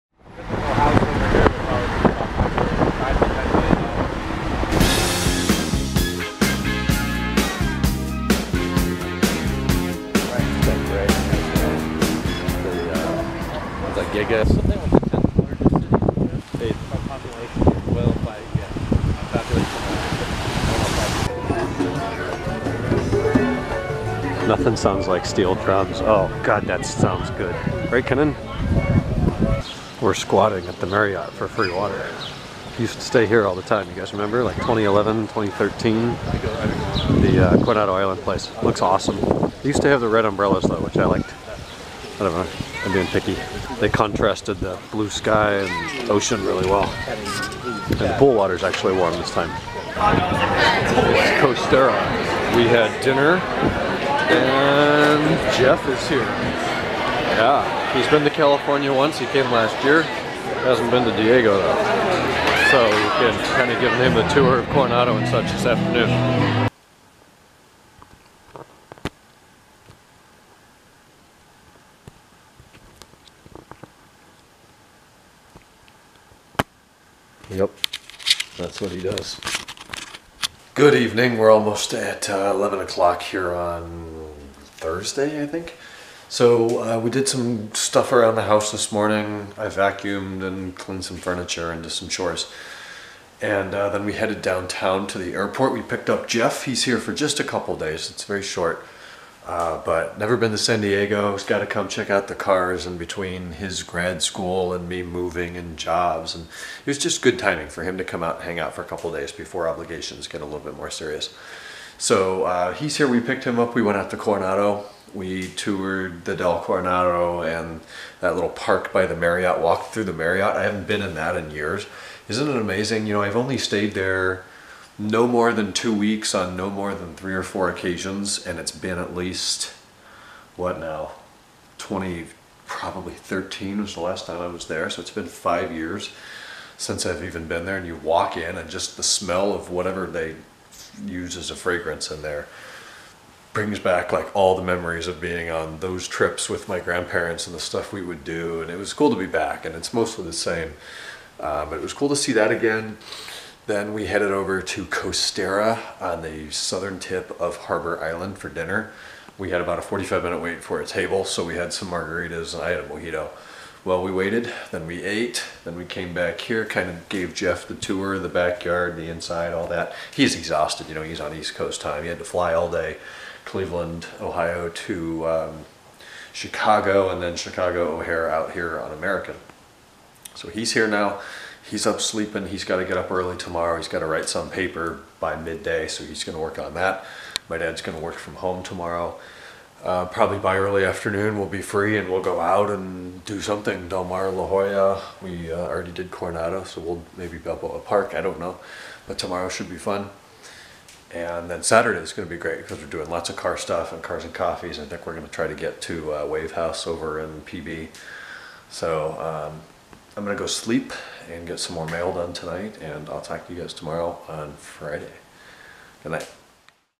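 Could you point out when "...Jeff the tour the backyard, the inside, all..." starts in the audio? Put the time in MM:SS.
02:47.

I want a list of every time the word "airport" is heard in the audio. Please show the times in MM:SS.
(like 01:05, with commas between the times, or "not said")
01:35.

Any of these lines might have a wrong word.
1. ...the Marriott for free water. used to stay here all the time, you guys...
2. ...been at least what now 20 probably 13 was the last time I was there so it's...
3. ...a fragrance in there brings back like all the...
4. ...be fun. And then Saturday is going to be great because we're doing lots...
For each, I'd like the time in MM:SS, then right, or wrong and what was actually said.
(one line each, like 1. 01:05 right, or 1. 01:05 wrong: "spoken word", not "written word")
1. 00:30 right
2. 02:08 right
3. 02:21 right
4. 03:19 right.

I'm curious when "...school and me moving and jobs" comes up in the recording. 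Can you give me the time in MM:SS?
01:44.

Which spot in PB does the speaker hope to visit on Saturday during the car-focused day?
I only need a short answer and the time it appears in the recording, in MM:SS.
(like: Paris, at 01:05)
Wave House, at 03:26.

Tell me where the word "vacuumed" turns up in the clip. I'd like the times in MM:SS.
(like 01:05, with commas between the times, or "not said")
01:29.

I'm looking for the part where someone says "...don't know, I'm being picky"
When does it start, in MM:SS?
00:42.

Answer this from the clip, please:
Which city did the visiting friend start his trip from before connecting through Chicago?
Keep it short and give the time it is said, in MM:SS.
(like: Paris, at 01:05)
Cleveland, Ohio, at 02:53.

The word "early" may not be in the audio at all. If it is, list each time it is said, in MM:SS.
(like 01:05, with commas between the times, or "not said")
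03:03, 03:10.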